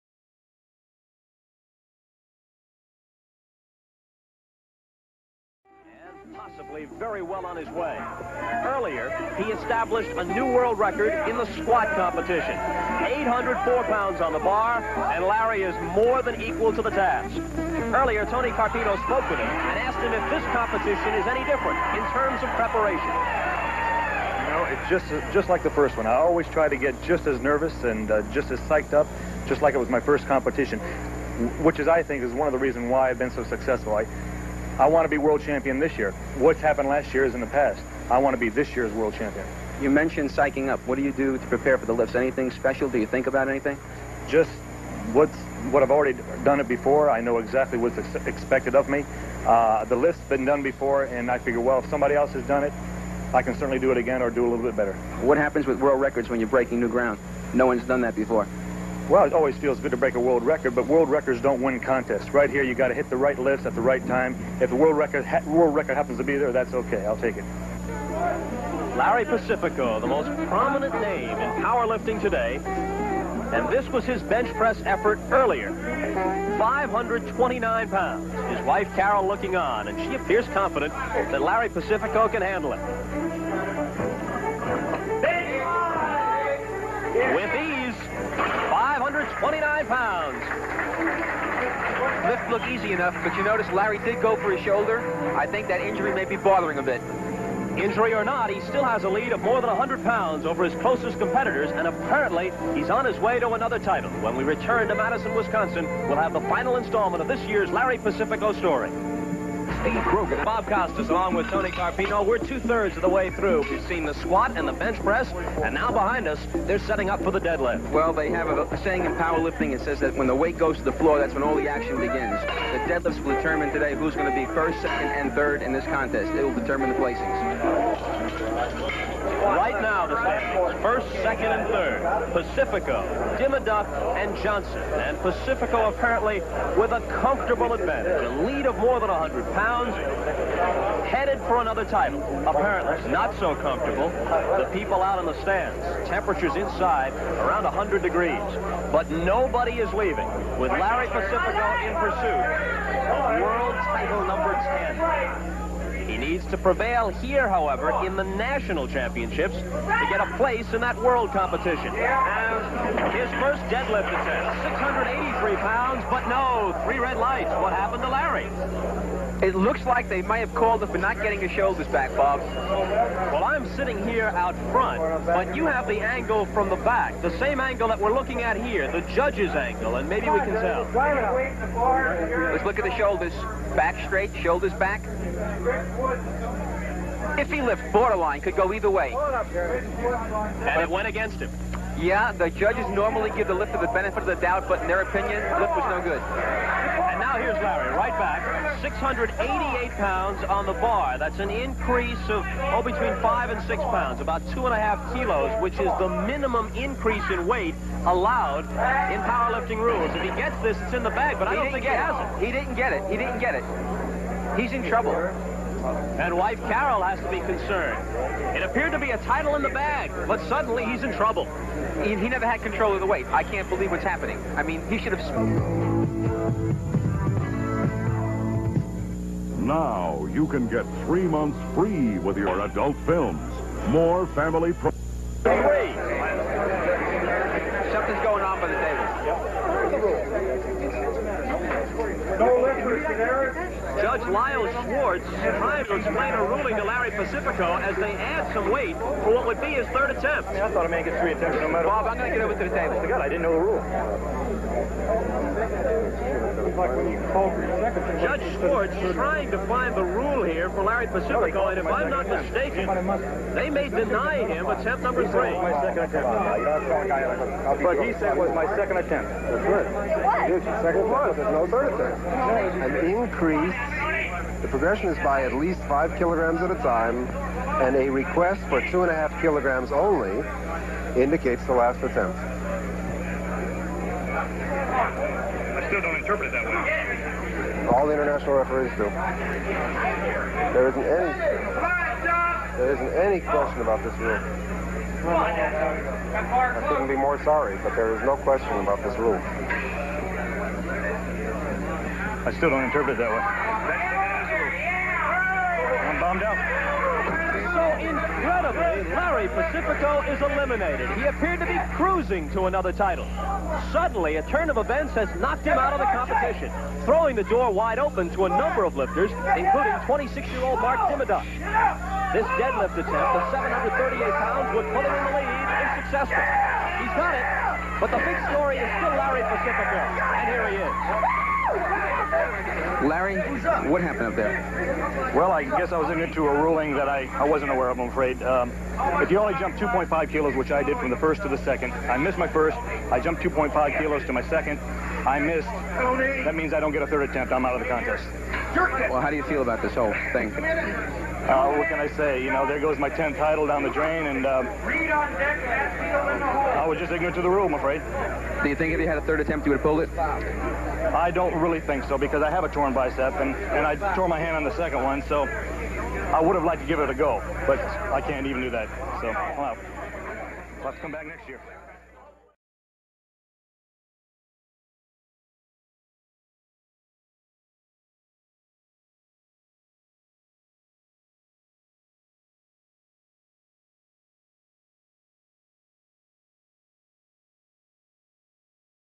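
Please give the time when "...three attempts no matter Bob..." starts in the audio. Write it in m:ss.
4:11.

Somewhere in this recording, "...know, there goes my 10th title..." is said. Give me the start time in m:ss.
5:52.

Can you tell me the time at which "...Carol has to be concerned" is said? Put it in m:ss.
3:36.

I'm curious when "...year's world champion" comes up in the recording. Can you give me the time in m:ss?
0:38.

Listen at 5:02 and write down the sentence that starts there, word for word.
I still don't interpret it that way.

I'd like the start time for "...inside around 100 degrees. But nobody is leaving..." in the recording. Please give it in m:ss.
2:26.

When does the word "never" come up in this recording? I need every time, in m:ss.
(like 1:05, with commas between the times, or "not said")
3:42.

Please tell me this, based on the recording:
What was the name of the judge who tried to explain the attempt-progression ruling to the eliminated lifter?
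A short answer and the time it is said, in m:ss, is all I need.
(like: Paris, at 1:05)
Lyle Schwartz, at 4:04.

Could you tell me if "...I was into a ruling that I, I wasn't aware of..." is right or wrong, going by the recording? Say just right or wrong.
right.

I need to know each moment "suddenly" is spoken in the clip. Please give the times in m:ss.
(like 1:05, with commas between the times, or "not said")
3:40, 5:13.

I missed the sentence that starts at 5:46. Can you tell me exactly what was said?
That means I don't get a third attempt.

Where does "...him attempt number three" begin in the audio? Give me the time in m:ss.
4:24.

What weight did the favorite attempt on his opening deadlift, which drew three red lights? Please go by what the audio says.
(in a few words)
683 pounds.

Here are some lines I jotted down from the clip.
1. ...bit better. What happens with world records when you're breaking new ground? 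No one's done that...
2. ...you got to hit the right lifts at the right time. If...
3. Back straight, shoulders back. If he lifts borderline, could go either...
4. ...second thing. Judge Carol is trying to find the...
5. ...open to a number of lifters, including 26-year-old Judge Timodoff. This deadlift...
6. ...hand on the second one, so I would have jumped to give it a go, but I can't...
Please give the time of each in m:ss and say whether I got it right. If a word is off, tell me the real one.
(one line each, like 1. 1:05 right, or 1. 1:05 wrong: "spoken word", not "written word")
1. 0:54 right
2. 1:02 right
3. 3:03 right
4. 4:17 wrong: "Schwartz", not "Carol"
5. 5:17 wrong: "Mark", not "Judge"
6. 6:04 wrong: "liked", not "jumped".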